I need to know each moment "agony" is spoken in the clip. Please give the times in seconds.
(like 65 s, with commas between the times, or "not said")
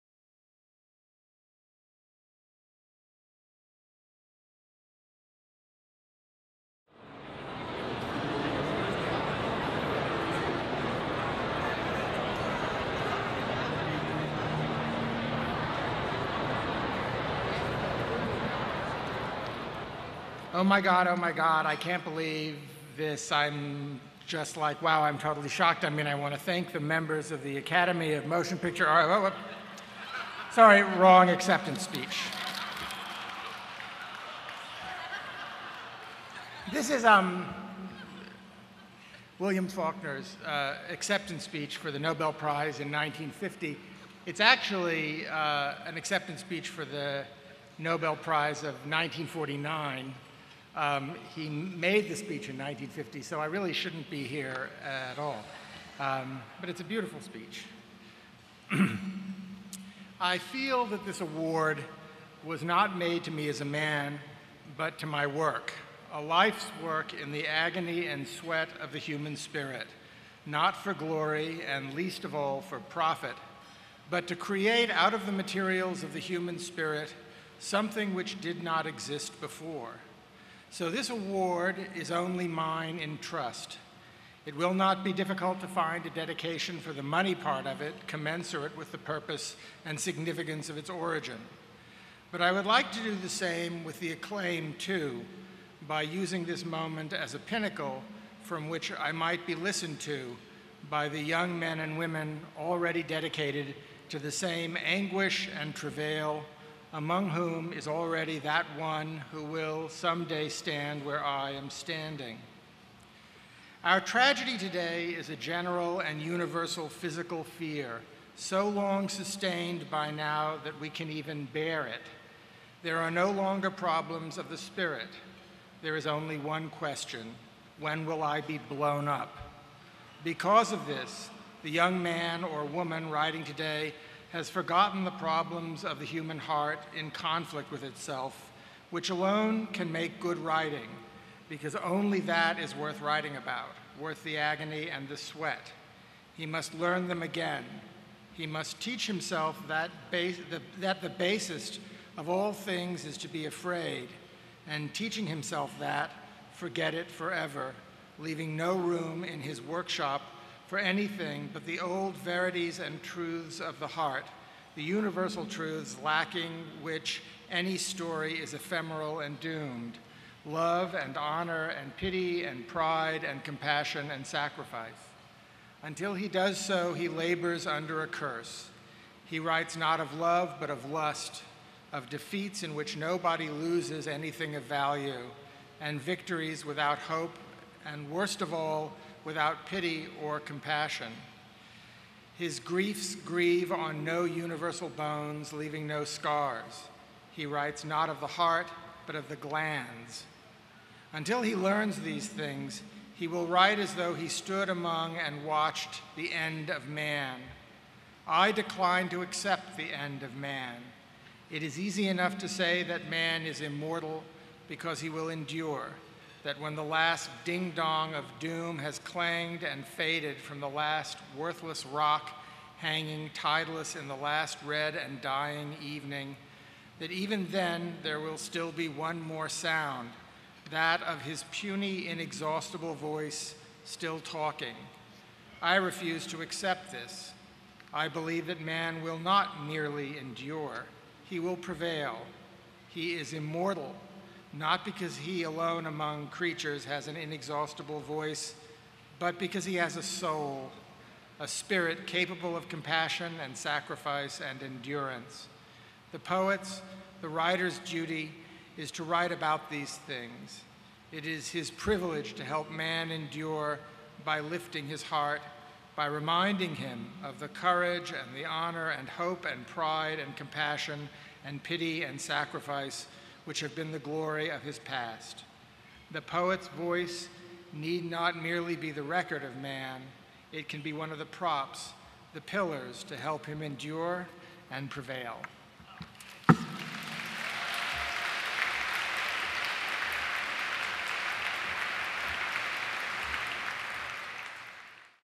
67 s, 144 s.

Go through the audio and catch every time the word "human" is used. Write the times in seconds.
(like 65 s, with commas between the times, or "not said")
68 s, 76 s, 136 s.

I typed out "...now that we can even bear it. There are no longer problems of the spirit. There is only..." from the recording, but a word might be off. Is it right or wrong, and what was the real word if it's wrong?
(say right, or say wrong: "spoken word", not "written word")
right.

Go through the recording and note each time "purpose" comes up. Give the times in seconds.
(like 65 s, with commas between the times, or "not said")
88 s.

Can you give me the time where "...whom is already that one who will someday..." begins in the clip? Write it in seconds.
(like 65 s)
107 s.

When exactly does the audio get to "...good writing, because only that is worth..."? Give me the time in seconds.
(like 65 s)
140 s.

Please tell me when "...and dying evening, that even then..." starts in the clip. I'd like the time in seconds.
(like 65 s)
224 s.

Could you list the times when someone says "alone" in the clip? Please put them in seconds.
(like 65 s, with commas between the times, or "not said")
139 s, 245 s.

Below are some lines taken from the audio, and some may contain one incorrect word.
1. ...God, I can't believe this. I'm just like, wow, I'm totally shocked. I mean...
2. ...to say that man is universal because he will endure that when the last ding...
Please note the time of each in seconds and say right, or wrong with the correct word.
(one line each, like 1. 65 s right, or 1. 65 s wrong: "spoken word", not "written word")
1. 21 s right
2. 212 s wrong: "immortal", not "universal".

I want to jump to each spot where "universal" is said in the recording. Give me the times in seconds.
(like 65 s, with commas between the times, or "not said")
116 s, 164 s, 194 s.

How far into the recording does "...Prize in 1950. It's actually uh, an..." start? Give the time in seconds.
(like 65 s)
42 s.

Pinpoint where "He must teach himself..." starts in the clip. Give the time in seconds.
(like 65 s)
148 s.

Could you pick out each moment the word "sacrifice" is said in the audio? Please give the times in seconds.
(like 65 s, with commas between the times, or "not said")
174 s, 253 s, 272 s.